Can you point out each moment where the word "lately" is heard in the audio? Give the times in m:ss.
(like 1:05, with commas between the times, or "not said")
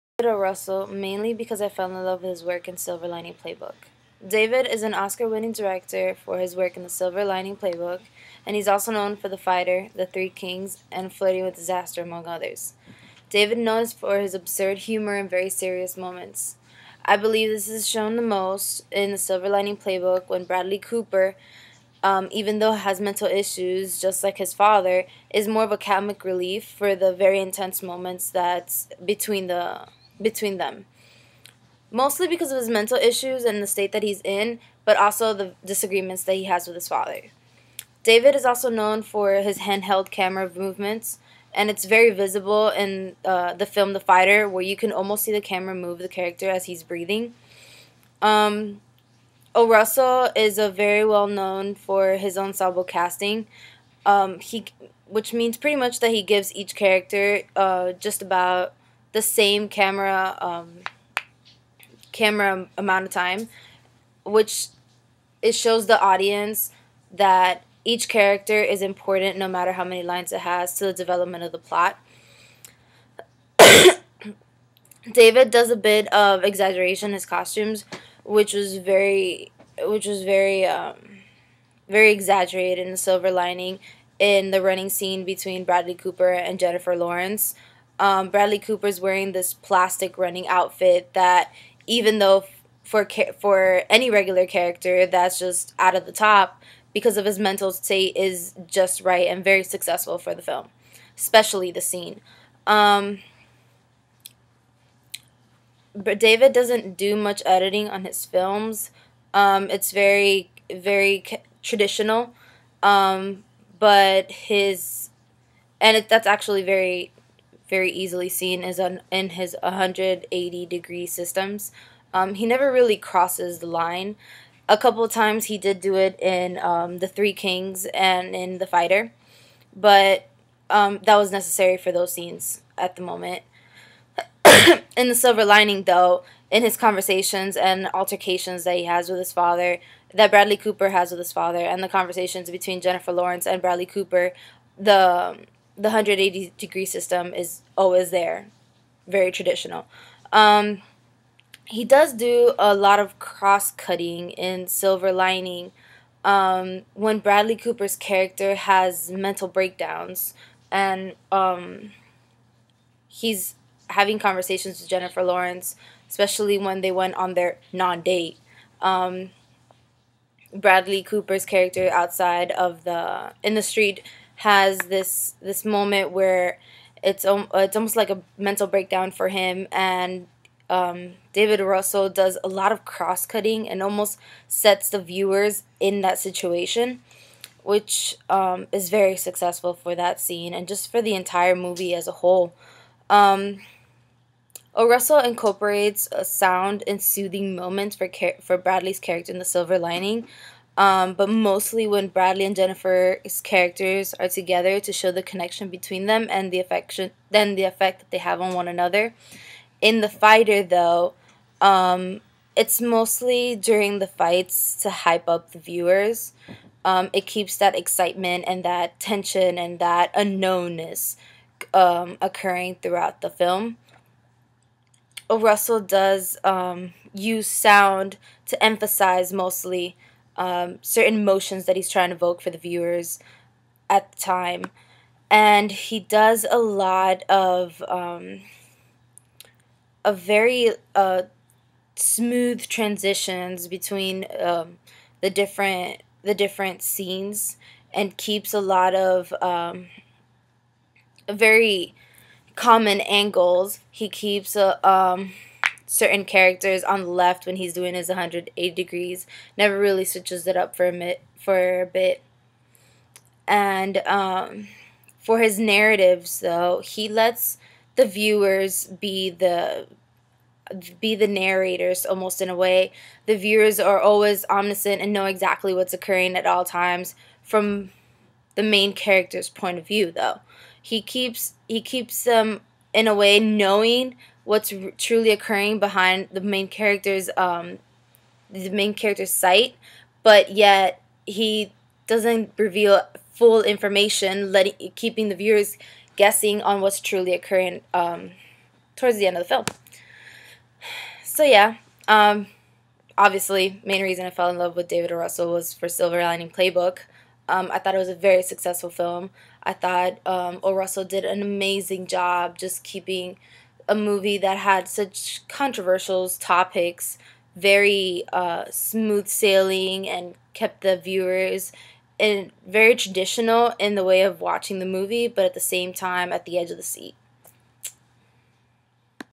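not said.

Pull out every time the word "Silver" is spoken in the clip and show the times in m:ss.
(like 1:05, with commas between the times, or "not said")
0:02, 0:06, 0:19, 1:22, 2:15, 2:34, 3:19, 5:05.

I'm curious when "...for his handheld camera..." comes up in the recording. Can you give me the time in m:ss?
0:39.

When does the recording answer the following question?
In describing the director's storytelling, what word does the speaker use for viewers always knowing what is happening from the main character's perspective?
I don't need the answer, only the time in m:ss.
4:34.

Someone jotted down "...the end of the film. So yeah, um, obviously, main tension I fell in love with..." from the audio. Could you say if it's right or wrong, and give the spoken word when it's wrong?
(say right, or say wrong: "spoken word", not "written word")
wrong: "reason", not "tension".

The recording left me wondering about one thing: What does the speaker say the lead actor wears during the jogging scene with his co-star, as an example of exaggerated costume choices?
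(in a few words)
plastic running outfit.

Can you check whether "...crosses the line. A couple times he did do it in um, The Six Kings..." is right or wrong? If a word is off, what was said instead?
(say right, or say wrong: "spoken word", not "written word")
wrong: "Three", not "Six".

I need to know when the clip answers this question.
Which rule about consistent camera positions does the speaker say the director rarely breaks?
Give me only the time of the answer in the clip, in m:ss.
1:59.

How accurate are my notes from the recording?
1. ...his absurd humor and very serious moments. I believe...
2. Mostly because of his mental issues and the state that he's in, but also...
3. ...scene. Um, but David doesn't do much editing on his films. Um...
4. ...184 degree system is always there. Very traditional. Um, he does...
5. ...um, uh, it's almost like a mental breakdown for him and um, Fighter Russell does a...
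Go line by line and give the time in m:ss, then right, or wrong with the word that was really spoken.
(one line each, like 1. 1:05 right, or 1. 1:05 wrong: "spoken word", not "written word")
1. 0:14 right
2. 0:31 right
3. 1:41 right
4. 2:25 wrong: "180", not "184"
5. 2:57 wrong: "David", not "Fighter".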